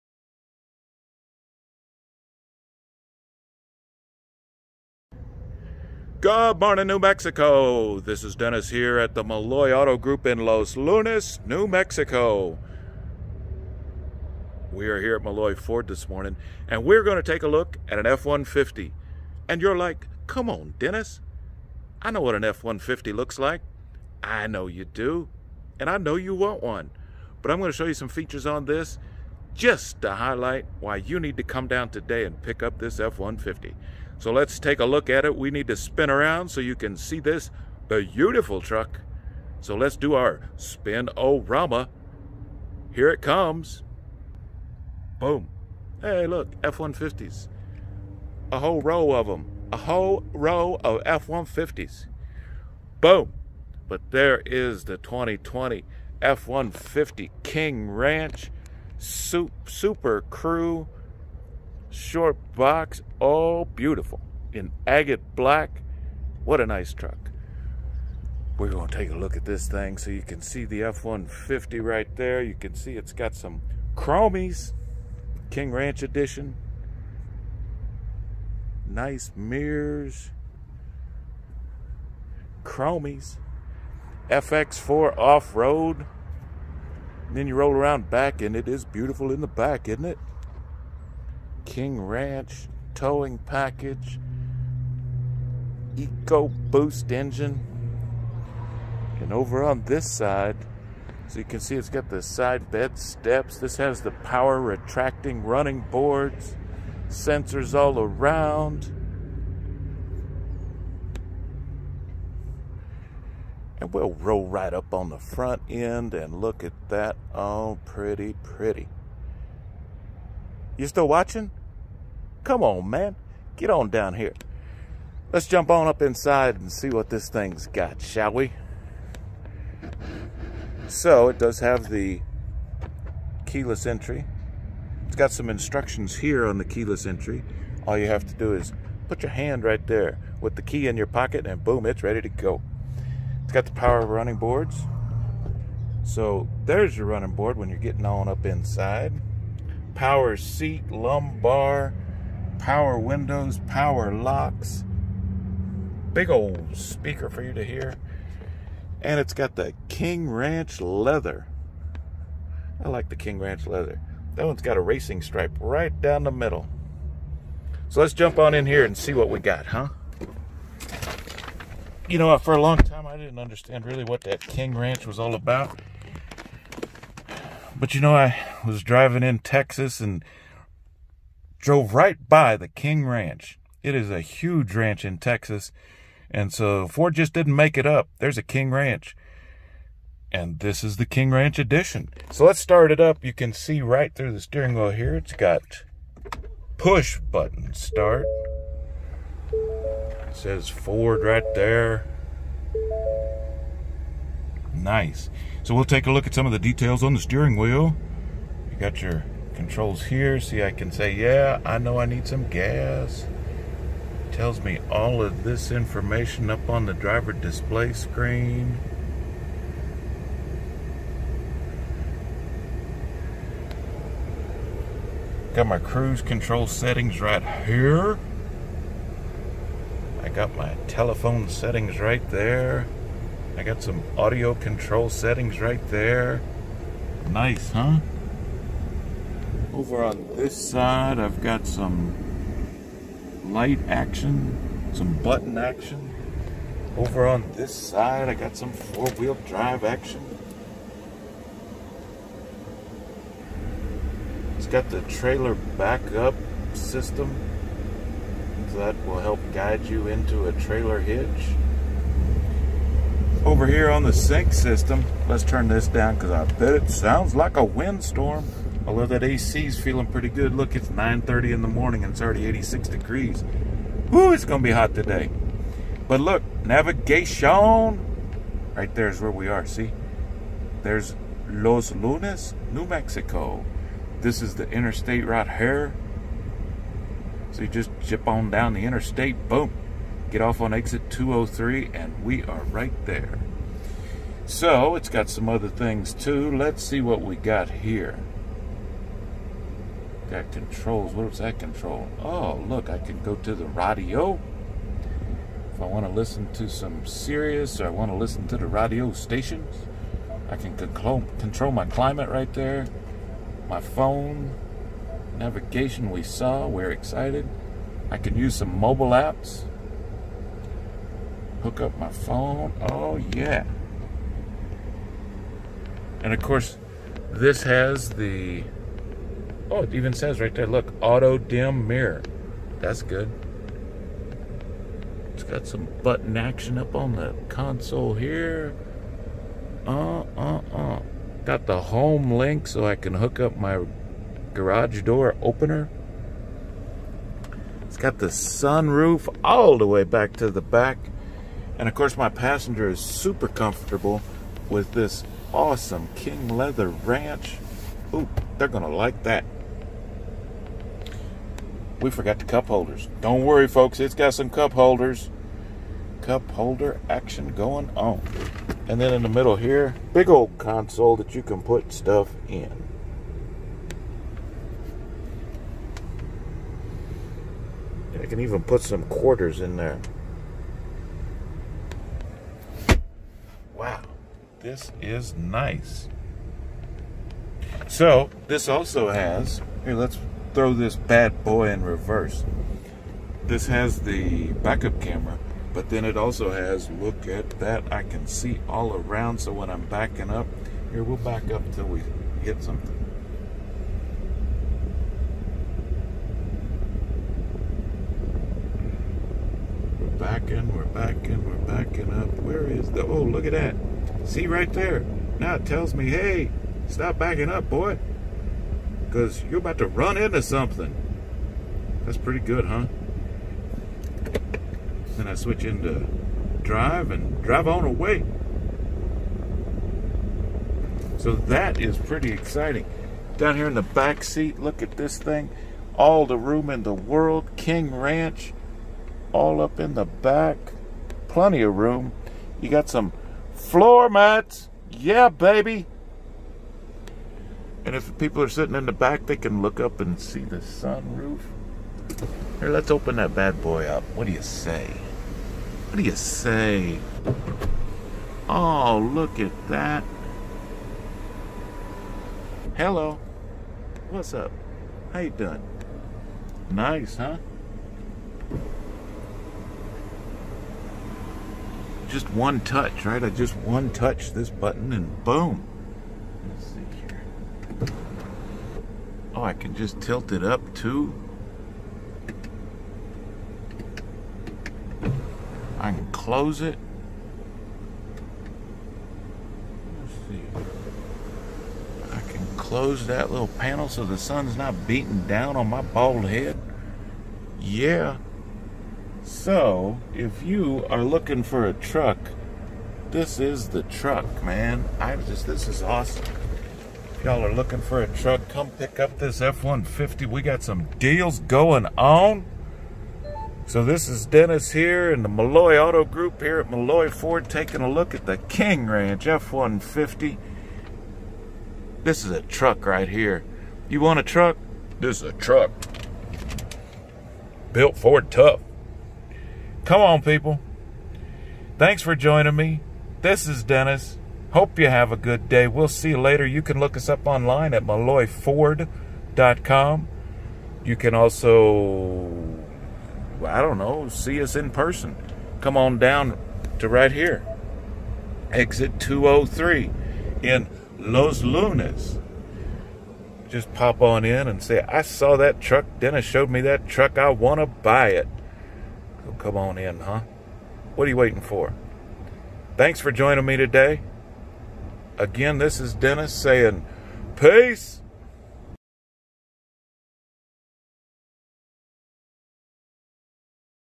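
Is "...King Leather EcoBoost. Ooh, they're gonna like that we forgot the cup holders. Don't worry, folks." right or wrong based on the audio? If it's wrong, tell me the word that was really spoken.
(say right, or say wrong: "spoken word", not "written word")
wrong: "Ranch", not "EcoBoost".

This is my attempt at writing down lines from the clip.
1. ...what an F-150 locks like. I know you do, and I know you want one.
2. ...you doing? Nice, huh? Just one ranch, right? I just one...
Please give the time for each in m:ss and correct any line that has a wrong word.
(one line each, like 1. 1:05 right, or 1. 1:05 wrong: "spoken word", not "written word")
1. 0:22 wrong: "looks", not "locks"
2. 7:45 wrong: "touch", not "ranch".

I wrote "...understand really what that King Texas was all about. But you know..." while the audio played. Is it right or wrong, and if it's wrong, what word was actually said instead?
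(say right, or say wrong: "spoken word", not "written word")
wrong: "Ranch", not "Texas".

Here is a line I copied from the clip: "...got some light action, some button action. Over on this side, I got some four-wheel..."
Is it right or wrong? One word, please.
right.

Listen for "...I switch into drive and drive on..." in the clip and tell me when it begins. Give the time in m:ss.
7:05.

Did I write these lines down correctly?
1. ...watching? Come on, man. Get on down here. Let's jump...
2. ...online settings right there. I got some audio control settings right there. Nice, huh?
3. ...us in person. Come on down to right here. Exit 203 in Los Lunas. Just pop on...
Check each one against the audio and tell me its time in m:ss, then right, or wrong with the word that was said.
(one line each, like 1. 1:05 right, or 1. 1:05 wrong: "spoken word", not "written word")
1. 2:01 right
2. 3:50 wrong: "telephone", not "online"
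3. 9:04 right.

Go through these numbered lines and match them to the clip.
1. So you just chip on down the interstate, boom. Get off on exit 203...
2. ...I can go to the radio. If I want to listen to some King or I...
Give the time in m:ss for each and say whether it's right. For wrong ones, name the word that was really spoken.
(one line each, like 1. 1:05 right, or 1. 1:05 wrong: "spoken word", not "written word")
1. 4:47 right
2. 5:02 wrong: "Sirius", not "King".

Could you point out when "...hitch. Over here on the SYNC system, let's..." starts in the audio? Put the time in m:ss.
4:20.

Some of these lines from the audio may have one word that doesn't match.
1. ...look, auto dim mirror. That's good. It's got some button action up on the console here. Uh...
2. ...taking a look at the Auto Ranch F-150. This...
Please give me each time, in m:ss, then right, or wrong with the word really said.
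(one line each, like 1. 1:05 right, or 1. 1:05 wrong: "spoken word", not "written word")
1. 5:30 right
2. 8:37 wrong: "King", not "Auto".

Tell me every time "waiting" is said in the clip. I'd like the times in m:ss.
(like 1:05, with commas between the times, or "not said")
9:21.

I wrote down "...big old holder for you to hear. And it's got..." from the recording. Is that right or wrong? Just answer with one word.
wrong.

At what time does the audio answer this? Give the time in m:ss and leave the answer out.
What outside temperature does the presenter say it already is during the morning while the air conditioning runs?
4:32.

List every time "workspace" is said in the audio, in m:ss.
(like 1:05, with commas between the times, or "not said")
not said.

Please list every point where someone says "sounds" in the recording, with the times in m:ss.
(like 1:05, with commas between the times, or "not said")
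4:26.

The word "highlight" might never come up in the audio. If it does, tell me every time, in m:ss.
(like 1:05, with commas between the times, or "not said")
0:30.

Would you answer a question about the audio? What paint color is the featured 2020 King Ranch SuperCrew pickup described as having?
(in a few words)
agate black.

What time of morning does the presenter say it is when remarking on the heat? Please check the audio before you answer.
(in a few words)
9:30.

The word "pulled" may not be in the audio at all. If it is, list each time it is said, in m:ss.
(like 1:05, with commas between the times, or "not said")
not said.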